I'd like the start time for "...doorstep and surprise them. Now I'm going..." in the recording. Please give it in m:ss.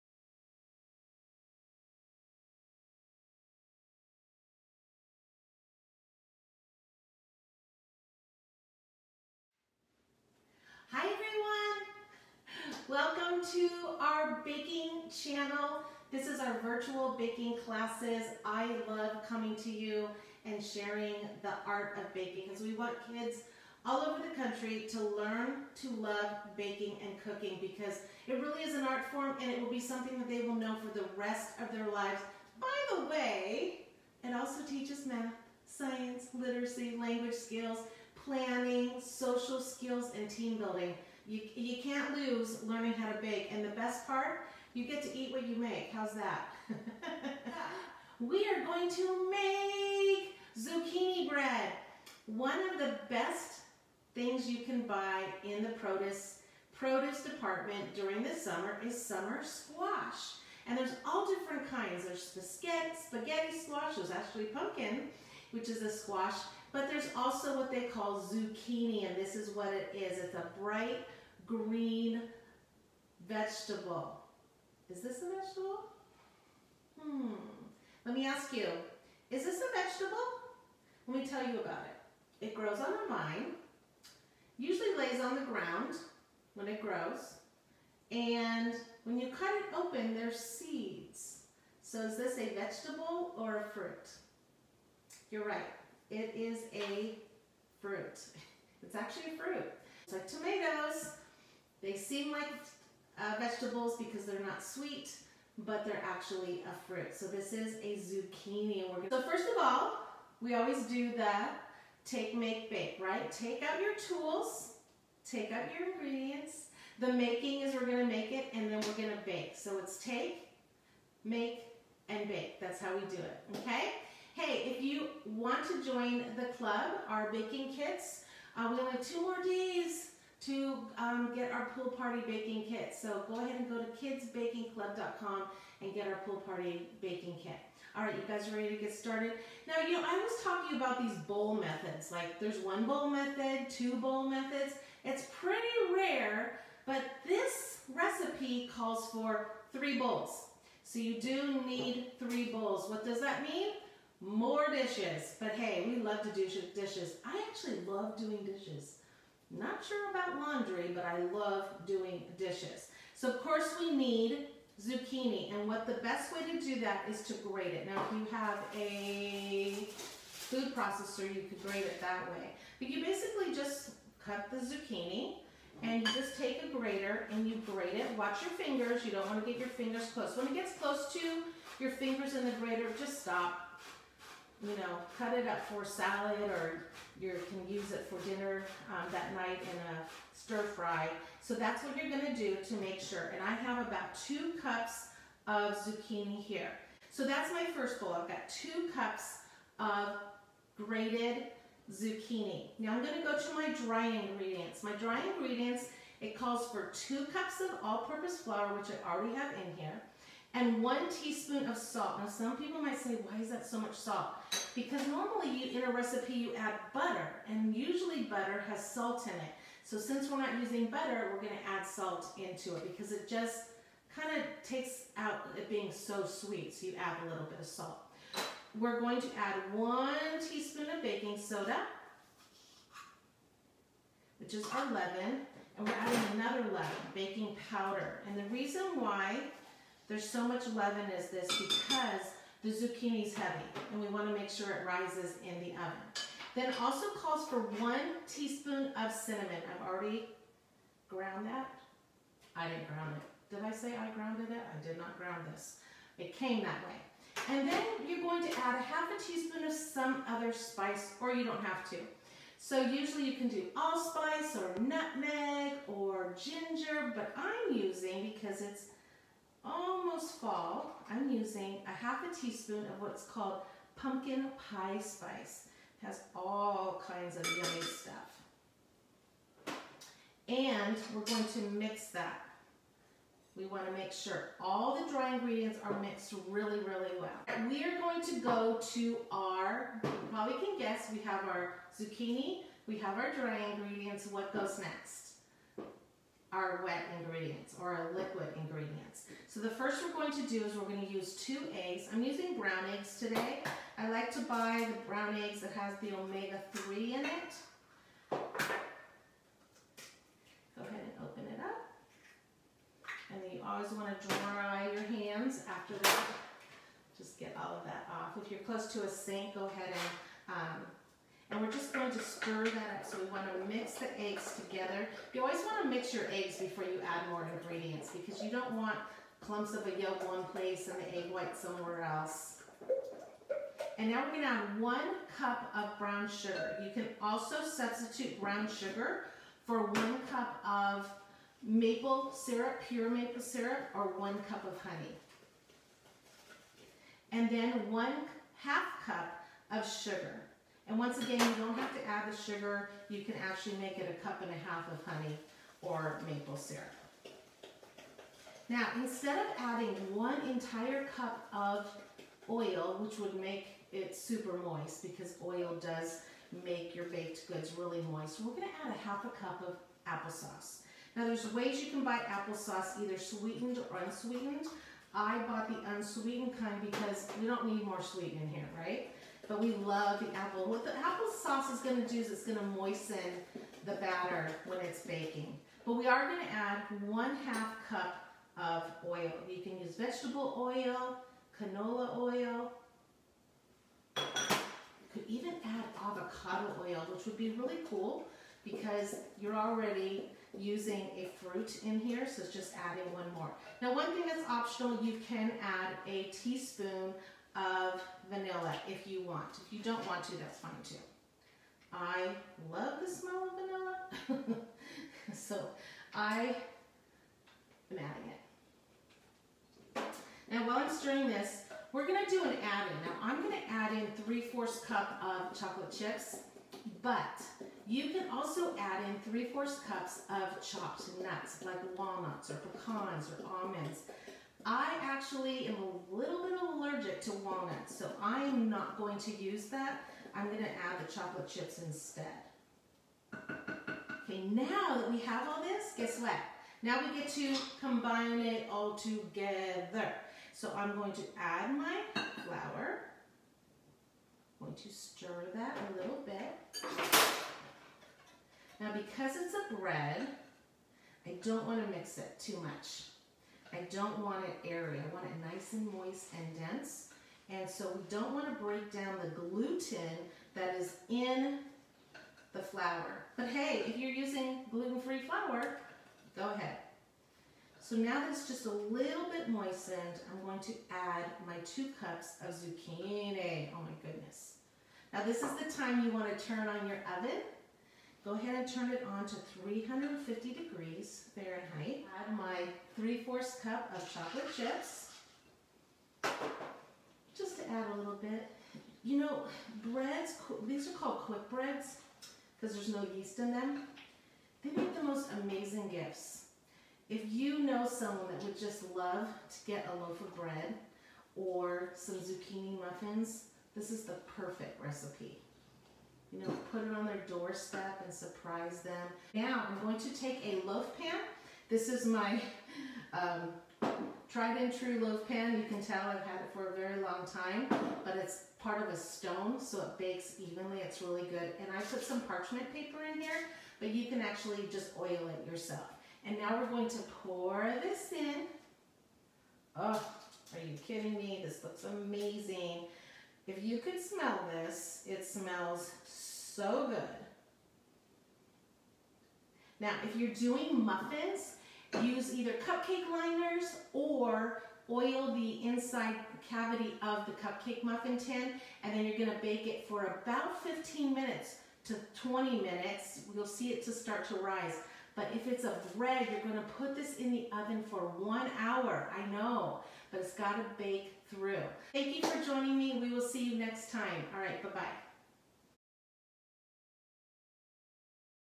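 8:37.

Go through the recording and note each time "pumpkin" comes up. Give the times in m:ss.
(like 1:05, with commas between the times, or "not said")
1:04, 4:33.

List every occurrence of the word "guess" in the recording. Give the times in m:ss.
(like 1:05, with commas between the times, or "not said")
4:50, 7:25.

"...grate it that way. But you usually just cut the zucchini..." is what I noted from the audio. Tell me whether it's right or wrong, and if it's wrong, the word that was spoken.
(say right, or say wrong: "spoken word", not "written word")
wrong: "basically", not "usually".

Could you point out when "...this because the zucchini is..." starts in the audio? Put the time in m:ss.
4:01.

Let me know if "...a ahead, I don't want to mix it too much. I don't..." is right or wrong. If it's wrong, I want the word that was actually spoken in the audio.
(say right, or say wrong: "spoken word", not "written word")
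wrong: "bread", not "ahead".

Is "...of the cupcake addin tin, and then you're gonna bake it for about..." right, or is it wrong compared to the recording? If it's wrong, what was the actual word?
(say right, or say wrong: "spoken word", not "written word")
wrong: "muffin", not "addin".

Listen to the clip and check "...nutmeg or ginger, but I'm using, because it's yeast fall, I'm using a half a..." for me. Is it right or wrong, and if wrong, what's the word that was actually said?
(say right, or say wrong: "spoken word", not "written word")
wrong: "almost", not "yeast".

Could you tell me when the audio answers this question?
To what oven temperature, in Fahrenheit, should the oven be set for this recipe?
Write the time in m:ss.
8:09.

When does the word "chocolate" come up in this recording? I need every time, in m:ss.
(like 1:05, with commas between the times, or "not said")
7:05, 7:21, 8:14.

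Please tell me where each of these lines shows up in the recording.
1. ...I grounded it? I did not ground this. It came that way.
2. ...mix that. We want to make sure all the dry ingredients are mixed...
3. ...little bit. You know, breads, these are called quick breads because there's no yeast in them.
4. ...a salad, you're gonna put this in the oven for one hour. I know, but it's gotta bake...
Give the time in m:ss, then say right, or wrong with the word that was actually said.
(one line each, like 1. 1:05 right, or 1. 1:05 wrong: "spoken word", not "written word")
1. 4:13 right
2. 4:41 right
3. 8:17 right
4. 9:25 wrong: "bread", not "salad".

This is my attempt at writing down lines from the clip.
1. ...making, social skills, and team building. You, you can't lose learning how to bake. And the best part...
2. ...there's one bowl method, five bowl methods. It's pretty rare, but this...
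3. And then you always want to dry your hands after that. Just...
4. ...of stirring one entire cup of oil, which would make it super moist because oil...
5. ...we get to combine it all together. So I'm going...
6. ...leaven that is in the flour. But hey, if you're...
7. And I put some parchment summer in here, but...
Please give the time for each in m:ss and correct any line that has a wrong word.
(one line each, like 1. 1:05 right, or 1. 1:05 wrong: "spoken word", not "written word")
1. 0:38 wrong: "planning", not "making"
2. 2:22 wrong: "two", not "five"
3. 5:13 right
4. 5:59 wrong: "adding", not "stirring"
5. 7:27 right
6. 7:49 wrong: "gluten", not "leaven"
7. 8:51 wrong: "paper", not "summer".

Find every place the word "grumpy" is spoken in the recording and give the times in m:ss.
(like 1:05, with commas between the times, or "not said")
not said.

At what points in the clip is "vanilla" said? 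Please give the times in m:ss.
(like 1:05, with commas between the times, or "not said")
6:48, 6:54.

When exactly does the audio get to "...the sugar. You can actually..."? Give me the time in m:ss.
5:52.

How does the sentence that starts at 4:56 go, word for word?
our wet ingredients or our liquid ingredients.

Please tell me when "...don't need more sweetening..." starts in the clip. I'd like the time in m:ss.
6:17.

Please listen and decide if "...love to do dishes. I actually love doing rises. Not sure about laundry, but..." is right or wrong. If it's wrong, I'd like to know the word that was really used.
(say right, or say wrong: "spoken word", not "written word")
wrong: "dishes", not "rises".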